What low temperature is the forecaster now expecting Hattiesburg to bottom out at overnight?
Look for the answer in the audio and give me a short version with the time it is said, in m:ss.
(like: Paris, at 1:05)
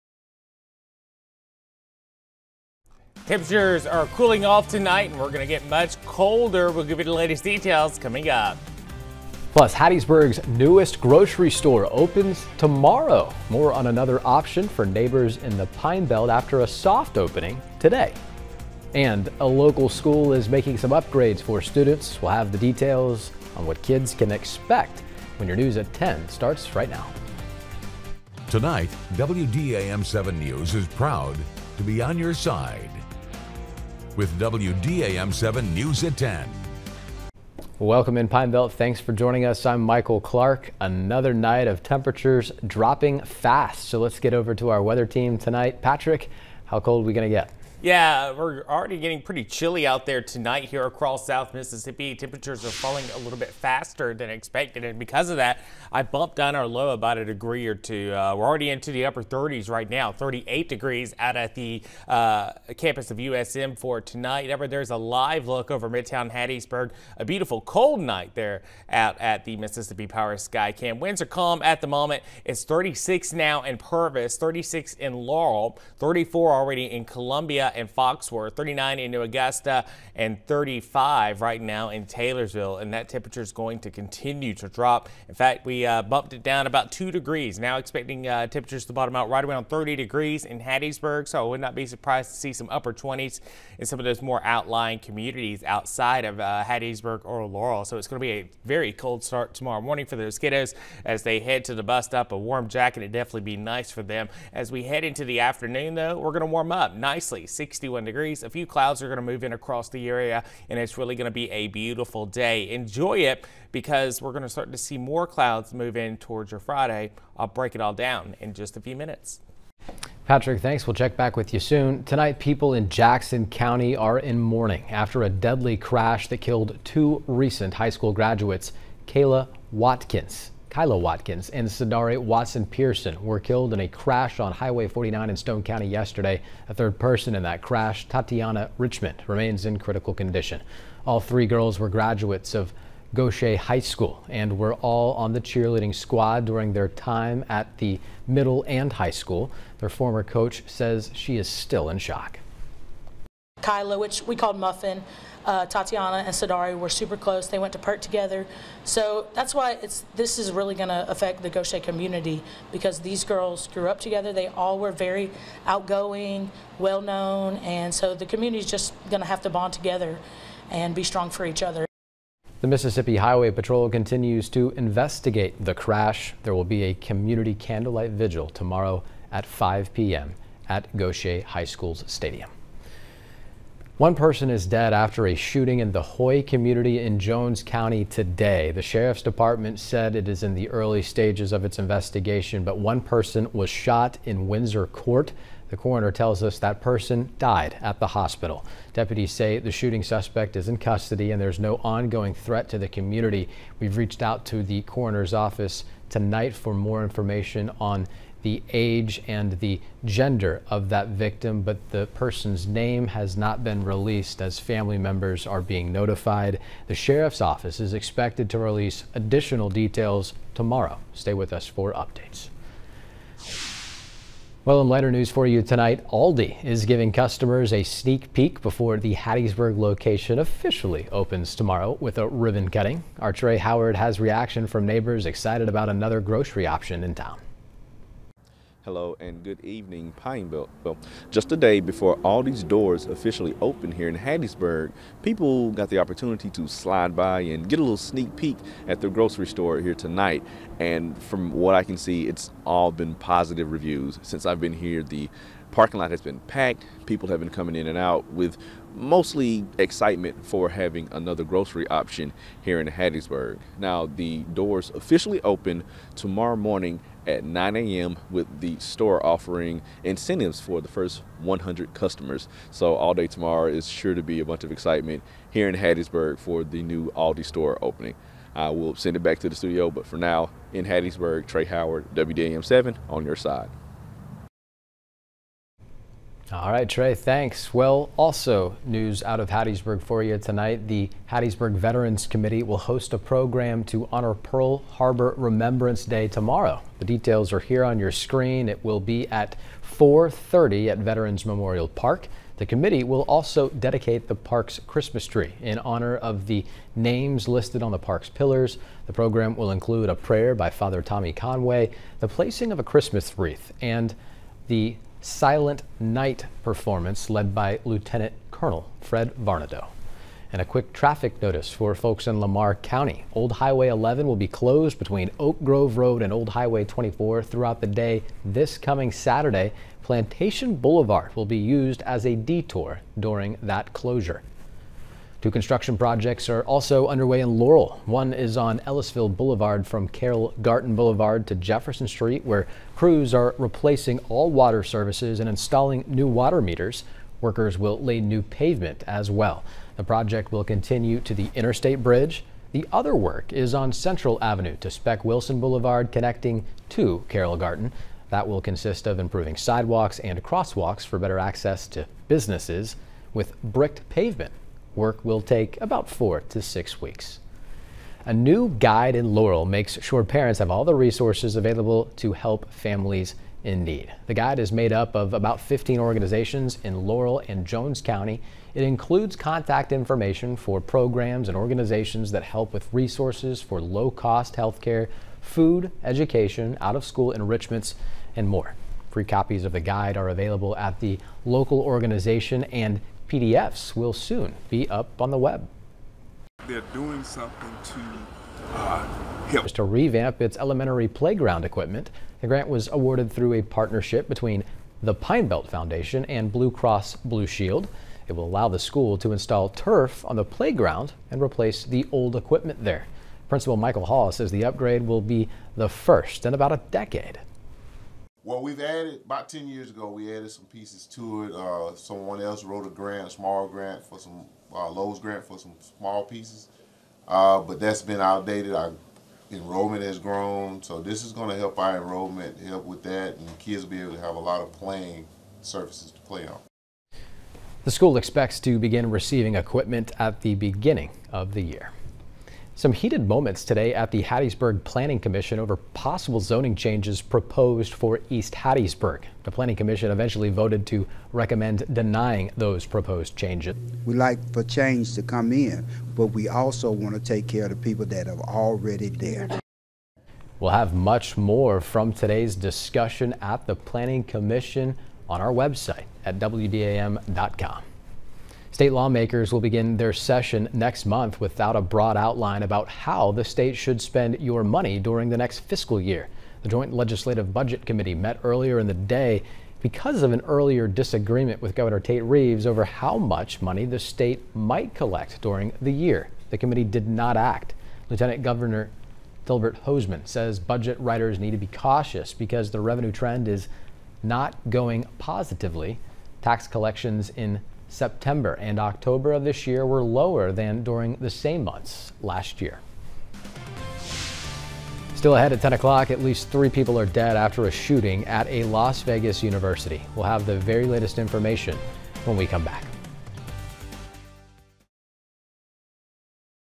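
30 degrees, at 1:29.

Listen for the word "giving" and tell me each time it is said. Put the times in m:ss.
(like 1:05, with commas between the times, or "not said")
3:46.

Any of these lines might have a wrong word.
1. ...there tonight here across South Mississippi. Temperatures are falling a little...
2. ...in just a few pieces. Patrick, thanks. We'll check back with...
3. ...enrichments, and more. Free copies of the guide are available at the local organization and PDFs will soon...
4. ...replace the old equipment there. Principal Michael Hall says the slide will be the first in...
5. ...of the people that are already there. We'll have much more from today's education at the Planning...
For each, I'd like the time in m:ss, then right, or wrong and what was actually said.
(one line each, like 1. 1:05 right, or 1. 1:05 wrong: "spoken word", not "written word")
1. 0:50 right
2. 1:58 wrong: "minutes", not "pieces"
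3. 6:27 right
4. 6:51 wrong: "upgrade", not "slide"
5. 7:37 wrong: "discussion", not "education".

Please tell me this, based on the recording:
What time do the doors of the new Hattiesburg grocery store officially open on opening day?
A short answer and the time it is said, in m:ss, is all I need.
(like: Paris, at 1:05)
9 a.m., at 4:27.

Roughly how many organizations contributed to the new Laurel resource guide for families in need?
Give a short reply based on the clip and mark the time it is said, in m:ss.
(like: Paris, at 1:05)
15, at 6:15.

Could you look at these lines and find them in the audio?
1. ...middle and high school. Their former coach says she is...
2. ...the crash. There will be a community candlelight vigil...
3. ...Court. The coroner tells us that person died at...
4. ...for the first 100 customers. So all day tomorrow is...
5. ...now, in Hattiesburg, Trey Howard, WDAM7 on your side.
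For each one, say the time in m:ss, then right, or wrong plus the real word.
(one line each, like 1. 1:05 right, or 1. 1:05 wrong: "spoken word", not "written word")
1. 2:28 right
2. 2:55 right
3. 3:14 right
4. 4:30 right
5. 4:40 right.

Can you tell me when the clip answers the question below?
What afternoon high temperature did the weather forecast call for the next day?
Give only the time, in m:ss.
1:47.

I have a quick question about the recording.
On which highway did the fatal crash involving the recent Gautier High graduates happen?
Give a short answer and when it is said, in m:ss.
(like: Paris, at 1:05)
Highway 49, at 2:14.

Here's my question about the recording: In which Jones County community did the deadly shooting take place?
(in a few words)
Hoy.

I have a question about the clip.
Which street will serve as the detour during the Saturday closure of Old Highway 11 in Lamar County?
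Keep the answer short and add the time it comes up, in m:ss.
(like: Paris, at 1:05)
Plantation Boulevard, at 5:30.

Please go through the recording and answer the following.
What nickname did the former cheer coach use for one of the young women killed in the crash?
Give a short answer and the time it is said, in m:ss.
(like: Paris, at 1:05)
Muffin, at 2:34.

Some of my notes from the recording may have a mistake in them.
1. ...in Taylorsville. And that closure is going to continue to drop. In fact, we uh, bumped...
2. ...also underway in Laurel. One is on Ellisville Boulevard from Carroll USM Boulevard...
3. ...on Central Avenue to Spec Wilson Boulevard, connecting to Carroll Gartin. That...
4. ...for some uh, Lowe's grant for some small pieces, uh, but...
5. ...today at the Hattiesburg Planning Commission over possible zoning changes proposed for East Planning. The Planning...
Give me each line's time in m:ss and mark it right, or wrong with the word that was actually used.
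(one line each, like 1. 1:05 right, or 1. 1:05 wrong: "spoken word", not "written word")
1. 1:21 wrong: "temperature", not "closure"
2. 5:36 wrong: "Gartin", not "USM"
3. 5:53 right
4. 7:04 right
5. 7:23 wrong: "Hattiesburg", not "Planning".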